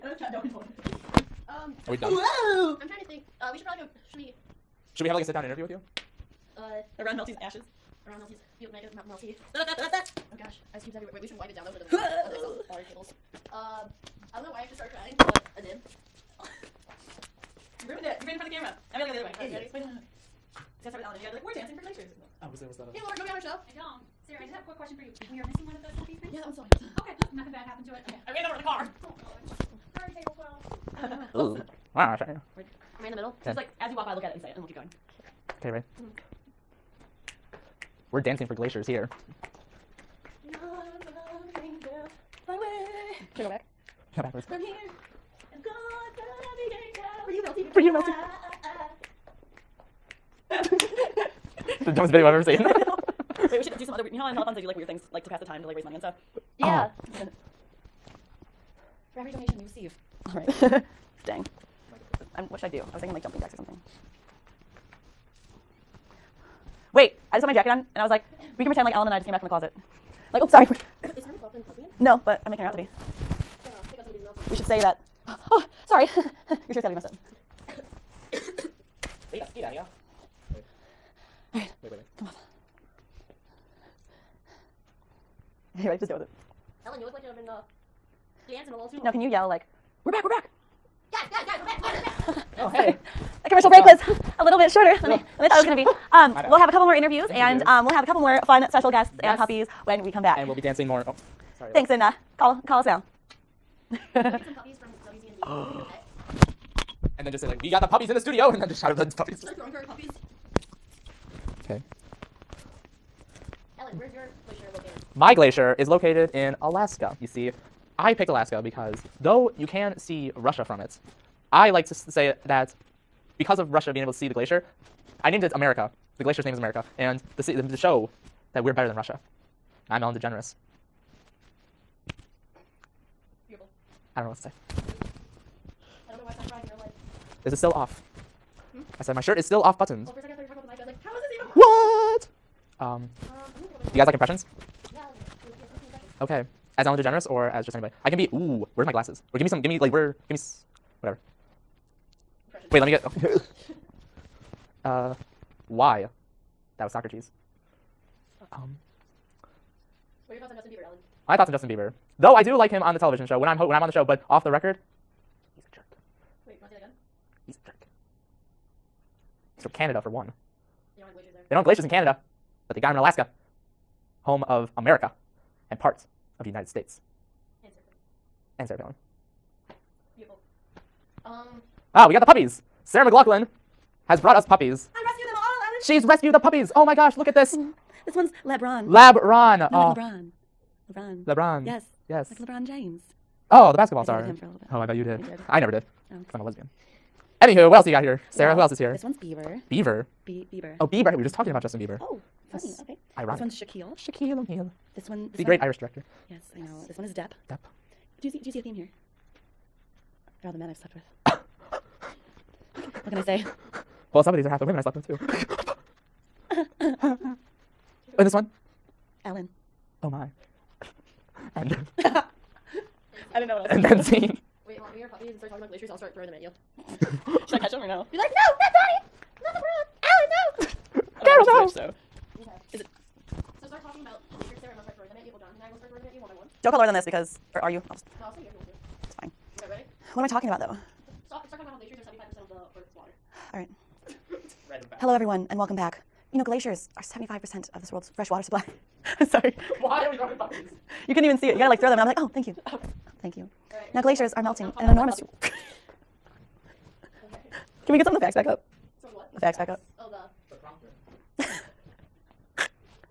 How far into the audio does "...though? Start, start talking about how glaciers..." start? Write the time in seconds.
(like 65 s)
240 s.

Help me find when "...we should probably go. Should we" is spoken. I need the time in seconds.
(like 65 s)
3 s.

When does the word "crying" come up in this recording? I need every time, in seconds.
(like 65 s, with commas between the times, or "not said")
14 s, 136 s.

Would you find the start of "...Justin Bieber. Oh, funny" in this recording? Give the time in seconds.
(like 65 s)
201 s.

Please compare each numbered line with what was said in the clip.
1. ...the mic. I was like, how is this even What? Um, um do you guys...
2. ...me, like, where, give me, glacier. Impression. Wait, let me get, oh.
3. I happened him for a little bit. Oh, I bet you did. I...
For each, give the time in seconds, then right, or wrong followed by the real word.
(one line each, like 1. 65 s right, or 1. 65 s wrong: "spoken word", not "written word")
1. 140 s right
2. 149 s wrong: "whatever", not "glacier"
3. 194 s wrong: "dated", not "happened".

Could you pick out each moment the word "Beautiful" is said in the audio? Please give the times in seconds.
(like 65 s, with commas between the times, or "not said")
133 s, 180 s.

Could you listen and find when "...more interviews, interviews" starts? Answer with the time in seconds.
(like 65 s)
96 s.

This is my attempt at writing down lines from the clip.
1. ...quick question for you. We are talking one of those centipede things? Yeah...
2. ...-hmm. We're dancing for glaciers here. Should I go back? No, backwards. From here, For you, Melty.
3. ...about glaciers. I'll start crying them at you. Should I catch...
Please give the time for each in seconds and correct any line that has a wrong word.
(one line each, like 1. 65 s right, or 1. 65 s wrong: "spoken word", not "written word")
1. 24 s wrong: "missing", not "talking"
2. 36 s right
3. 225 s wrong: "throwing", not "crying".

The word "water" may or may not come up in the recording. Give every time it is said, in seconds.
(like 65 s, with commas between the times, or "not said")
242 s, 248 s.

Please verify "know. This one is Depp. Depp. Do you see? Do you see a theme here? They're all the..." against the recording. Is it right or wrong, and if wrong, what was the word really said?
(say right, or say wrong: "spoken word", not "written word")
right.